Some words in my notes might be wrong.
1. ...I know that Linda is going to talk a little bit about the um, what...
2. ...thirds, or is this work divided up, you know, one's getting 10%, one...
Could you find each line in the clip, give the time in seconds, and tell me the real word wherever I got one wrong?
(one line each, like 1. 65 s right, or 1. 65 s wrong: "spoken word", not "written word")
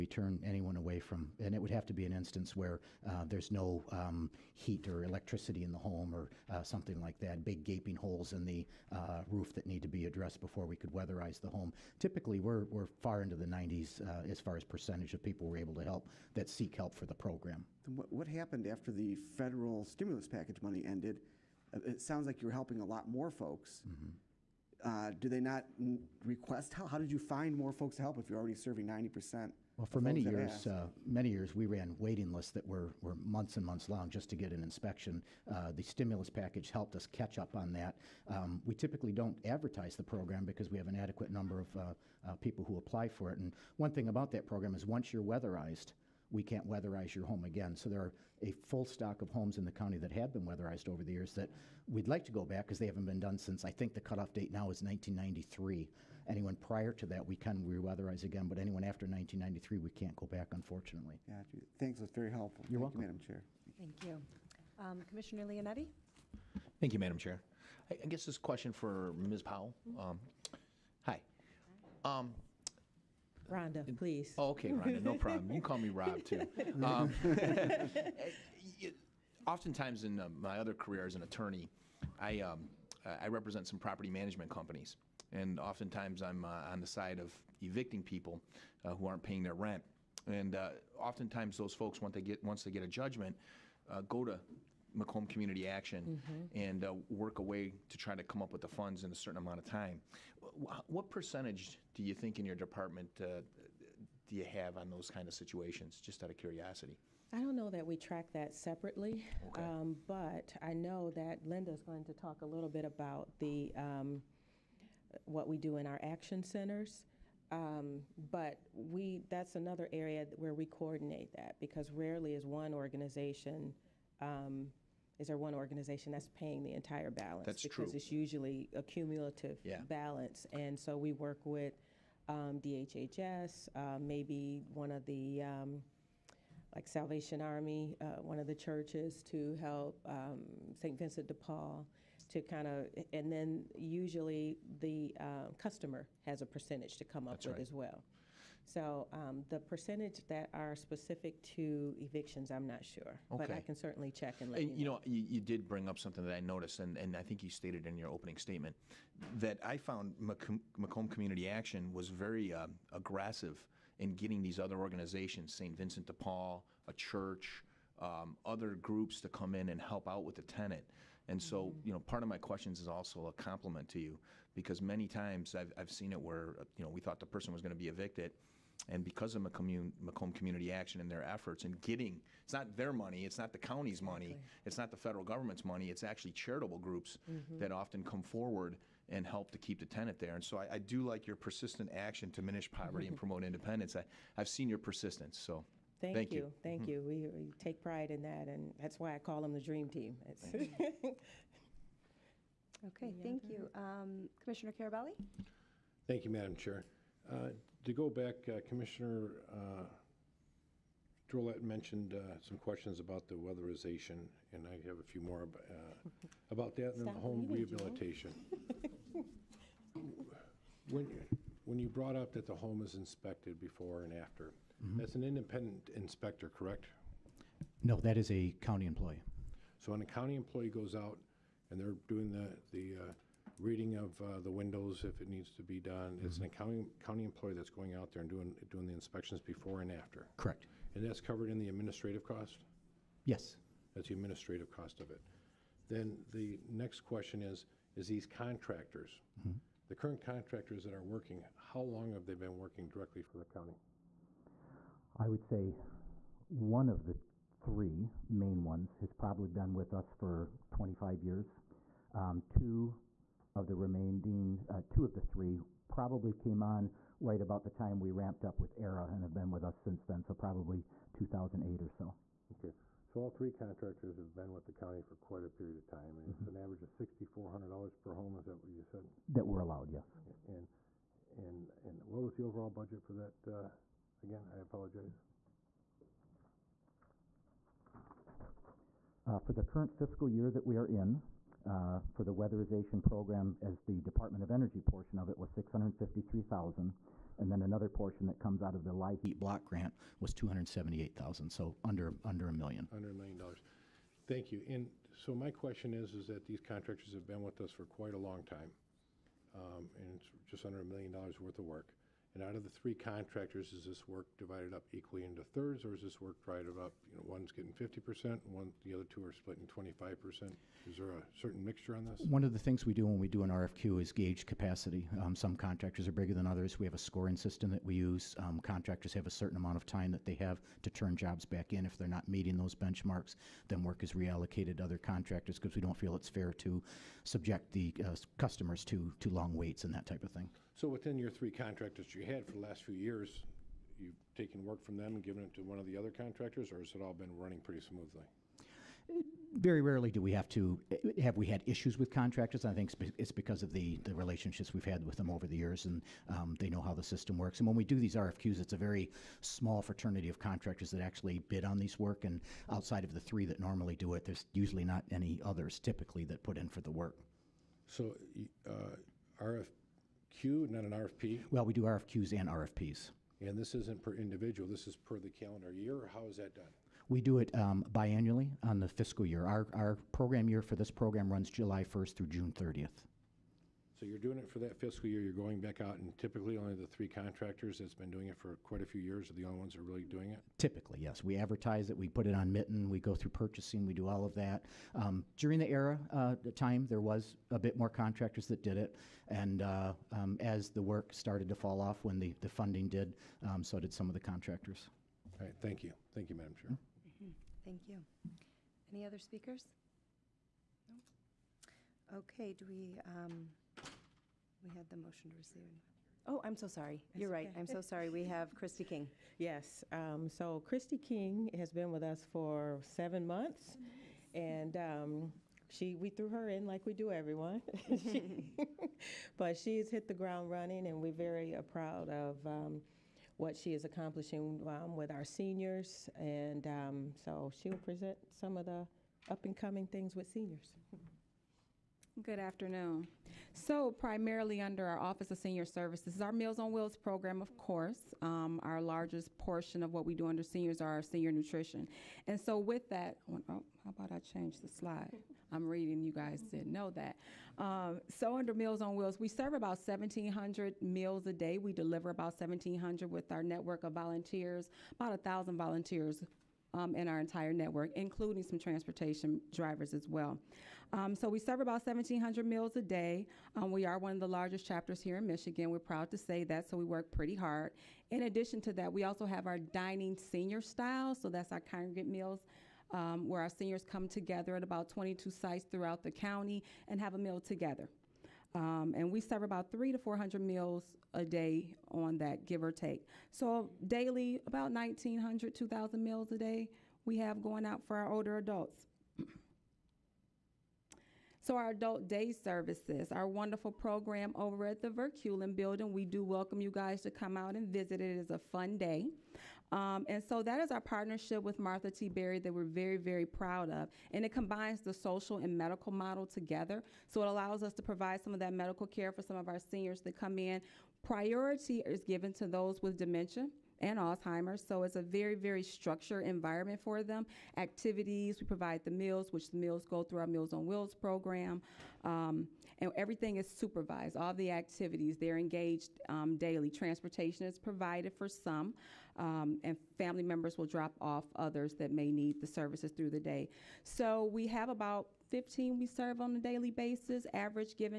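1. 110 s right
2. 315 s wrong: "50", not "10".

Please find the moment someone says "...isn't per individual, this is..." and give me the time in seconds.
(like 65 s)
373 s.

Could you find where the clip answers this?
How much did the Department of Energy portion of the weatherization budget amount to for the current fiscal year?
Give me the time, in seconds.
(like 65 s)
295 s.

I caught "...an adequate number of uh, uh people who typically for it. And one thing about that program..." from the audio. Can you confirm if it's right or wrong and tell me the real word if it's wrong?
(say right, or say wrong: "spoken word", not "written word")
wrong: "apply", not "typically".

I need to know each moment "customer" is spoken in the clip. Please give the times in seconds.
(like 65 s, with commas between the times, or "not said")
145 s, 338 s.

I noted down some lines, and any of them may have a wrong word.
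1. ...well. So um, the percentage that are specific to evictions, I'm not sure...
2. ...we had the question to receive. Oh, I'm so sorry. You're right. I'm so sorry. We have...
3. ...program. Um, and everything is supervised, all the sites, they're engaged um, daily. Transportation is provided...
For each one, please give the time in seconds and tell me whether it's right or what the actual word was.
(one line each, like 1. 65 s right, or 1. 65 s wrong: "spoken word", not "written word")
1. 147 s right
2. 414 s wrong: "motion", not "question"
3. 530 s wrong: "activities", not "sites".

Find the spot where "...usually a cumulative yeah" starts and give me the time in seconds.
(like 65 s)
128 s.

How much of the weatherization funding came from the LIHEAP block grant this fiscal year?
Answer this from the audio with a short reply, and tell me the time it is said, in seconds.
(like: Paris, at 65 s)
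278,000, at 300 s.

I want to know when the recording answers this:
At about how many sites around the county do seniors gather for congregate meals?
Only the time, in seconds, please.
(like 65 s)
484 s.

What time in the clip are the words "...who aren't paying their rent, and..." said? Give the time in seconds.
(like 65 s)
88 s.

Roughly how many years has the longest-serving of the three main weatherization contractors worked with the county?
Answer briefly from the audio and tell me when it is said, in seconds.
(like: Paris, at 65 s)
25 years, at 260 s.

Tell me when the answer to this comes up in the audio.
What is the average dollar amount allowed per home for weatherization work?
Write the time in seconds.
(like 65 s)
276 s.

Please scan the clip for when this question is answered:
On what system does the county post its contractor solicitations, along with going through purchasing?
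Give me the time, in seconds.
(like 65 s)
392 s.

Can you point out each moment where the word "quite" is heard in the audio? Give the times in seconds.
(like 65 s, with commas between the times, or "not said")
275 s, 307 s, 388 s.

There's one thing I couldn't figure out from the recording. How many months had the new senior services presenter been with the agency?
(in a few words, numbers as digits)
7 months.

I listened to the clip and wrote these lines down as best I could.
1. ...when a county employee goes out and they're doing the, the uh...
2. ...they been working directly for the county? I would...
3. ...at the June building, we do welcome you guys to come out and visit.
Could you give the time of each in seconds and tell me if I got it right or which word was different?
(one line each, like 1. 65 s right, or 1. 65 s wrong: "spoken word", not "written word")
1. 229 s right
2. 252 s right
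3. 504 s wrong: "Verculin", not "June".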